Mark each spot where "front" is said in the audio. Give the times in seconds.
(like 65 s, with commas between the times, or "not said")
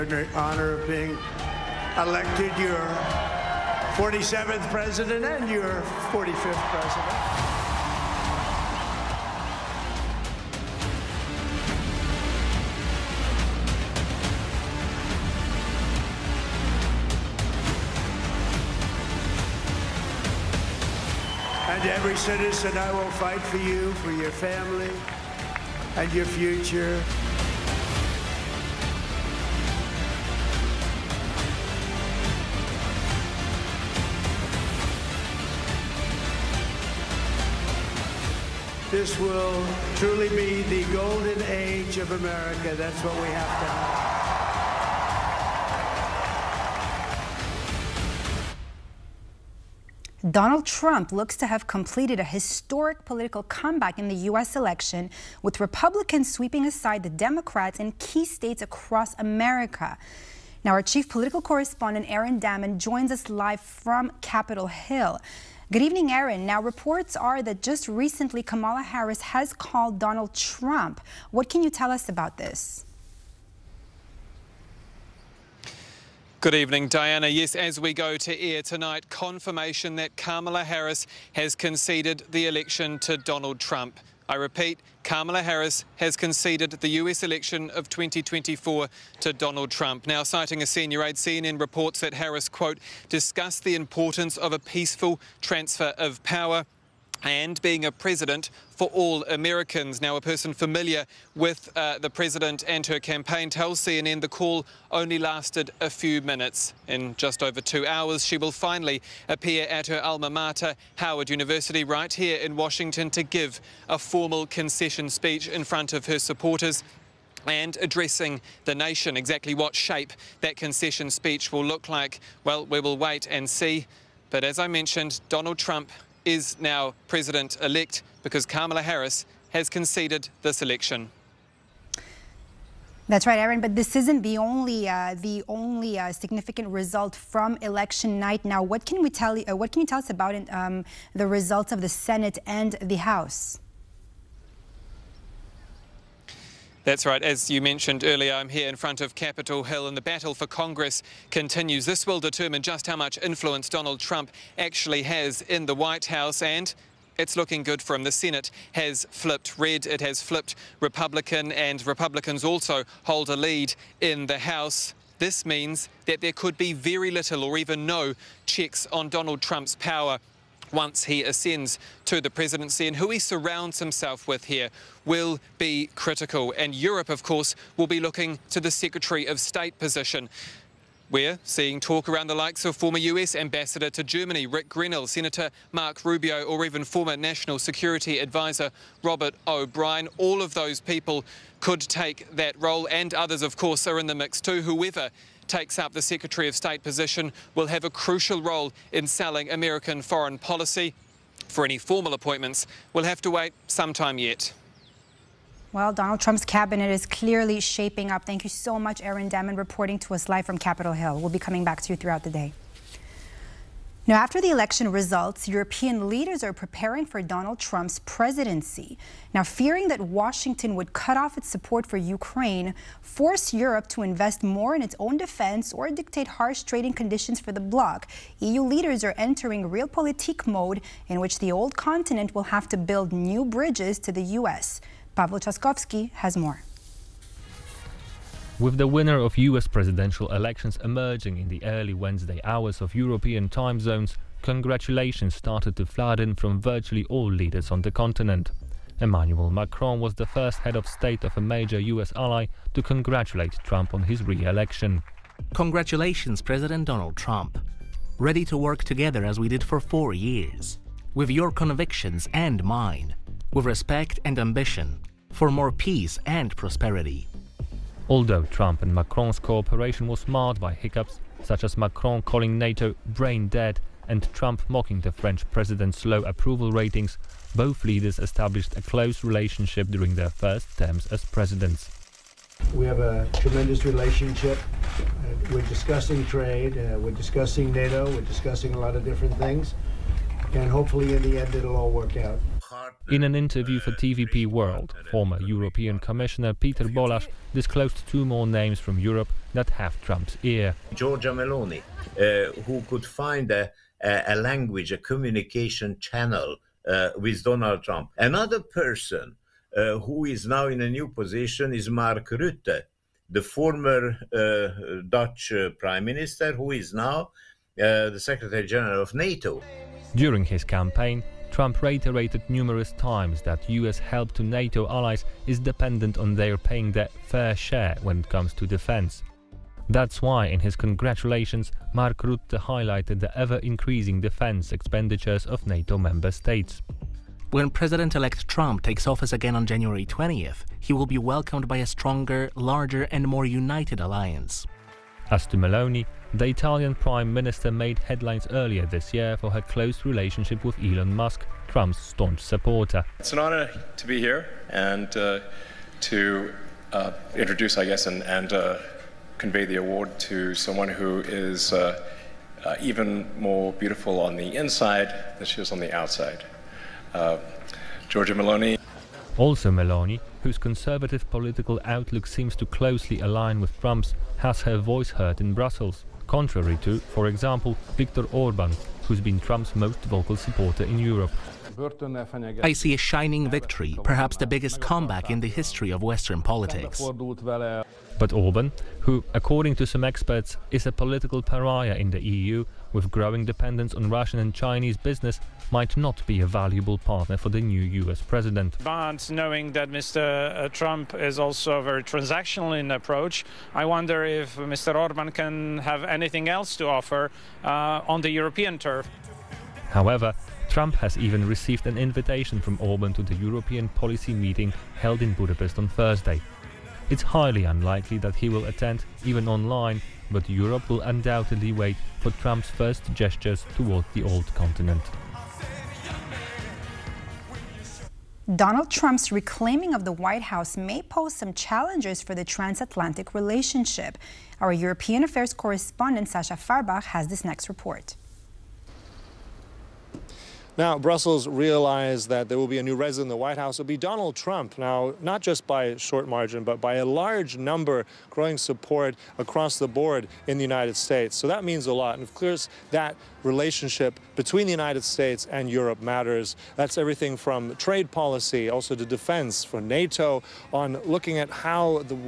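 115 s, 148 s.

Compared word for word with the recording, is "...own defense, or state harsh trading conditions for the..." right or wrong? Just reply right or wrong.
wrong.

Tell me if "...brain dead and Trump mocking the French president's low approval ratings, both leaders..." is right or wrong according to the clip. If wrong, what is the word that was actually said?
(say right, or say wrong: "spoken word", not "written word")
right.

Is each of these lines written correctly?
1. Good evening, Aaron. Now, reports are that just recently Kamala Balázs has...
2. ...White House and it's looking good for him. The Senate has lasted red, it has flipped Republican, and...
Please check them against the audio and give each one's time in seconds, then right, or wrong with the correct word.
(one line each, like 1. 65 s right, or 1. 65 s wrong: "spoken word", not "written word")
1. 65 s wrong: "Harris", not "Balázs"
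2. 155 s wrong: "flipped", not "lasted".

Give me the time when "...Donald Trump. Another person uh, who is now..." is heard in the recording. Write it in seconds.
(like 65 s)
307 s.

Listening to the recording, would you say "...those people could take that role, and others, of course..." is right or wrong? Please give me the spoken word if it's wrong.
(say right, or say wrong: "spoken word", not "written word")
right.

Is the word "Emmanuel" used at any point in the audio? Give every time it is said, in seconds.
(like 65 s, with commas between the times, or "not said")
248 s.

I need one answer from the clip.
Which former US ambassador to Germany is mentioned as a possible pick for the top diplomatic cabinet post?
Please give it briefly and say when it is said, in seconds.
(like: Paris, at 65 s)
Rick Grenell, at 184 s.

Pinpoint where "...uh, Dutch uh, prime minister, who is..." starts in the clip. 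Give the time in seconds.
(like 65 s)
314 s.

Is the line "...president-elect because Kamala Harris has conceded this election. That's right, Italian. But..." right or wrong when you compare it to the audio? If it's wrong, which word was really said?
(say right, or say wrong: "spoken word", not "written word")
wrong: "Aaron", not "Italian".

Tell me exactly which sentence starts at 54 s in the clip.
election, with Republicans sweeping aside the Democrats in key states across America.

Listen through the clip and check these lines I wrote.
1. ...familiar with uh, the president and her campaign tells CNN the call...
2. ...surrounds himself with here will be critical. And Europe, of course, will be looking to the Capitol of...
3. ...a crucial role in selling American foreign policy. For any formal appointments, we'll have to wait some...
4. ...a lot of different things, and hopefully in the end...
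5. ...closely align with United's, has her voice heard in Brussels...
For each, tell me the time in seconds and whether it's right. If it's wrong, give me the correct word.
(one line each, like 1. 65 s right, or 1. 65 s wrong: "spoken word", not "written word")
1. 100 s right
2. 173 s wrong: "Secretary", not "Capitol"
3. 197 s right
4. 288 s right
5. 372 s wrong: "Trump", not "United".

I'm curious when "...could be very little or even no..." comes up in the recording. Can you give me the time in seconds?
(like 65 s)
166 s.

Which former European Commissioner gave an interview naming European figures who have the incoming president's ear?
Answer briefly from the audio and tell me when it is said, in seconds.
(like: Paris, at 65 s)
Péter Balázs, at 296 s.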